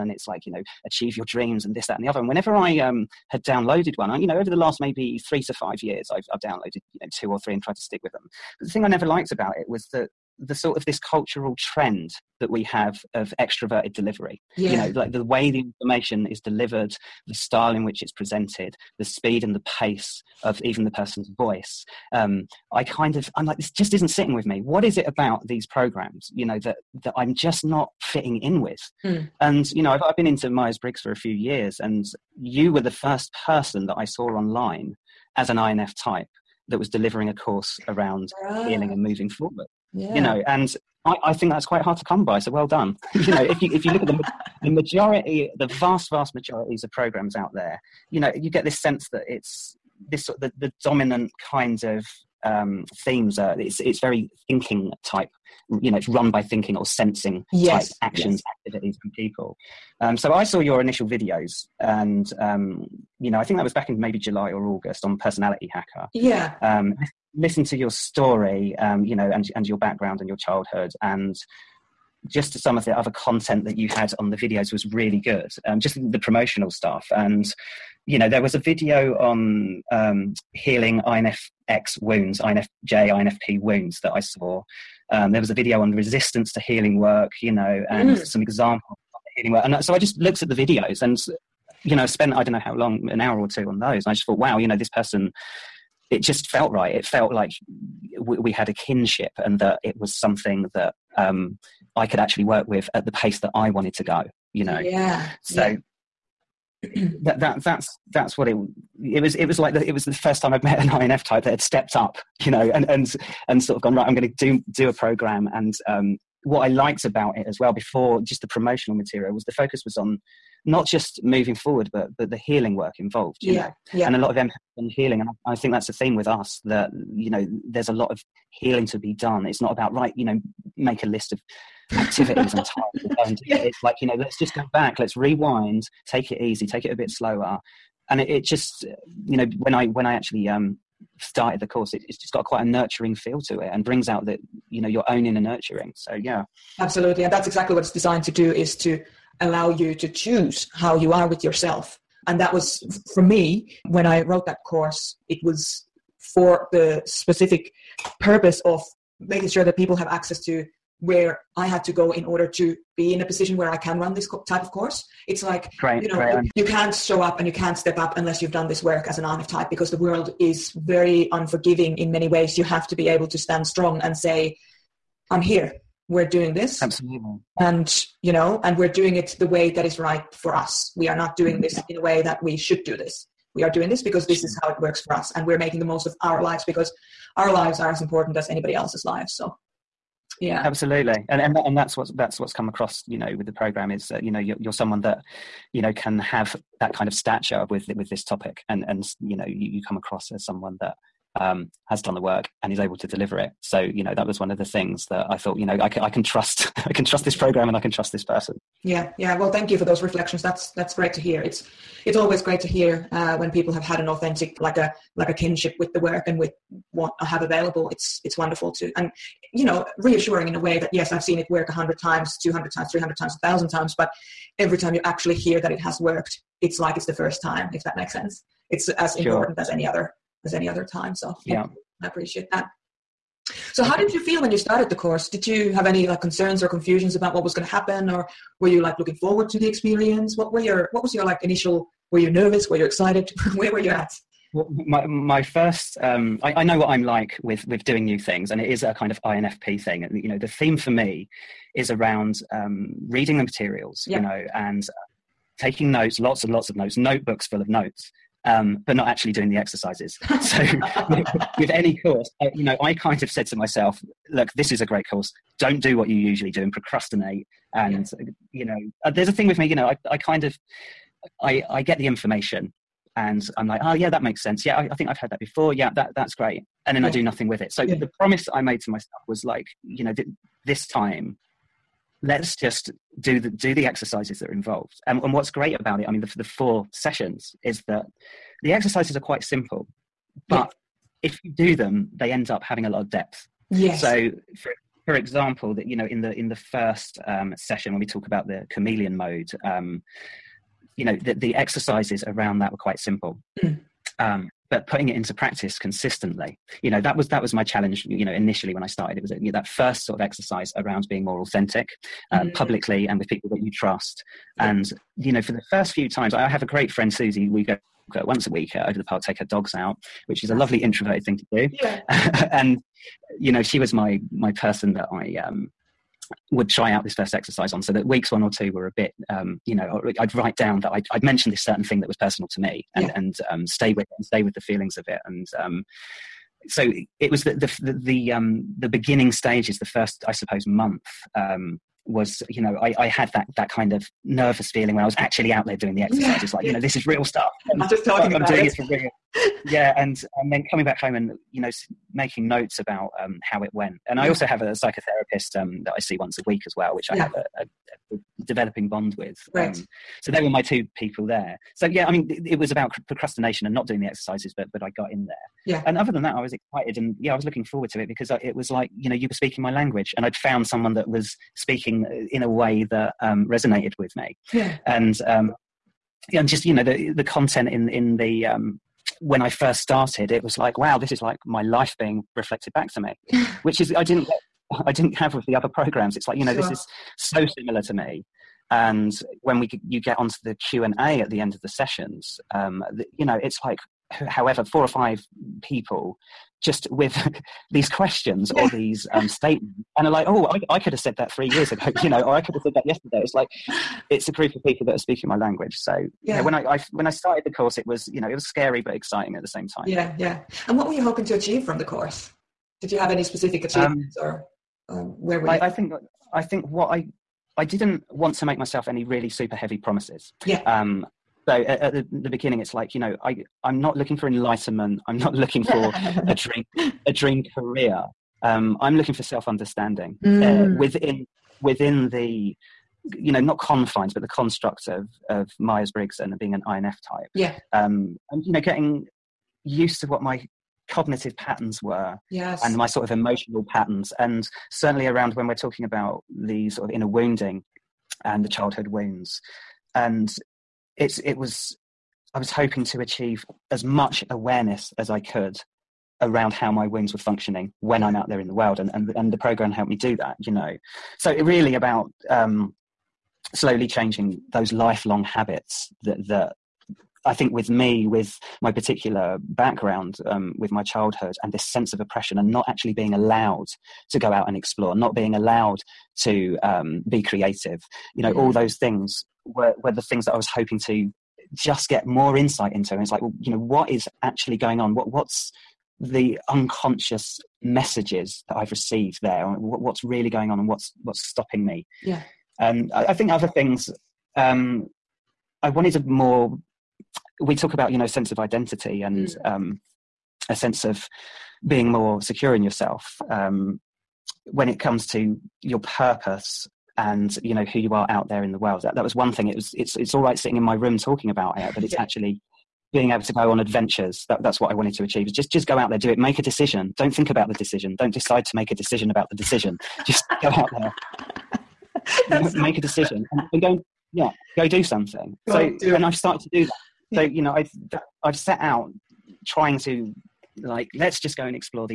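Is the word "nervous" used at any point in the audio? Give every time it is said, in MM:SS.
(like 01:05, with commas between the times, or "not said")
04:02, 05:44.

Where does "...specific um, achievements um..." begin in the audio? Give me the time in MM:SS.
06:53.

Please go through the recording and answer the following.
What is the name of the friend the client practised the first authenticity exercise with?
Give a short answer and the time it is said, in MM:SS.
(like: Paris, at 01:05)
Susie, at 05:17.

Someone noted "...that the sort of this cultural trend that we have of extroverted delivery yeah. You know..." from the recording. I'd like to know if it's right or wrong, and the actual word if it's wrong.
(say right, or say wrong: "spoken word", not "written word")
right.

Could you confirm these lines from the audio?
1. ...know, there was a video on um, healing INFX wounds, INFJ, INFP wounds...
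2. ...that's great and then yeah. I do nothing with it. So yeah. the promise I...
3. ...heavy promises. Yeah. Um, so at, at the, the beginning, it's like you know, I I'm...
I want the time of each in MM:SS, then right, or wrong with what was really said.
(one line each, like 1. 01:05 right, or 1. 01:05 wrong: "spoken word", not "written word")
1. 01:18 right
2. 04:36 right
3. 06:59 right.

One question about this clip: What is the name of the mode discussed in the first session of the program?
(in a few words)
chameleon mode.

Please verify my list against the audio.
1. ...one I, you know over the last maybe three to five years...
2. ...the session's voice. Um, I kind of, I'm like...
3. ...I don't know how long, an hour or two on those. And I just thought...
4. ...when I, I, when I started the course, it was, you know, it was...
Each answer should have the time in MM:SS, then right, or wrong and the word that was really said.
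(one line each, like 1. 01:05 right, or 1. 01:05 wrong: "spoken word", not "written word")
1. 00:03 right
2. 00:20 wrong: "person", not "session"
3. 01:32 right
4. 06:46 right.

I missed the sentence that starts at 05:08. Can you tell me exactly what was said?
You know, initially when I started, it was you know, that first sort of exercise around being more authentic, um, mm-hmm.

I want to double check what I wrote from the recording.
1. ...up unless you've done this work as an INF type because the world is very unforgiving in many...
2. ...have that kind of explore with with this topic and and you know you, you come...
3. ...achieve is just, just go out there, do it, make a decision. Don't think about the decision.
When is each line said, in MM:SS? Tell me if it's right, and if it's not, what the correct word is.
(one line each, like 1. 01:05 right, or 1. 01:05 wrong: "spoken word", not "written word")
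1. 02:47 right
2. 03:16 wrong: "stature", not "explore"
3. 08:35 right.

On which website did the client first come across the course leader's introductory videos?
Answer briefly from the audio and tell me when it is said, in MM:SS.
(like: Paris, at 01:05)
Personality Hacker, at 01:05.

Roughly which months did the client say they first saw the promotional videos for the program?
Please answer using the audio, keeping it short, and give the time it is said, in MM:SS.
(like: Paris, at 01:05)
July or August, at 01:04.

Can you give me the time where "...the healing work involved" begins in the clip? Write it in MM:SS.
02:02.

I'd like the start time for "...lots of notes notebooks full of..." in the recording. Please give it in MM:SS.
04:16.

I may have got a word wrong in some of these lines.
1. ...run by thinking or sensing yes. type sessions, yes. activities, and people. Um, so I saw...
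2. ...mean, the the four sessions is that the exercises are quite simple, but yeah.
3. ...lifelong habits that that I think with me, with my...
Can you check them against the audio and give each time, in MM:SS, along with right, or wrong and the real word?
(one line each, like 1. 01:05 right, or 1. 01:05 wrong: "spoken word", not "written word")
1. 00:56 wrong: "actions", not "sessions"
2. 04:46 right
3. 07:44 right.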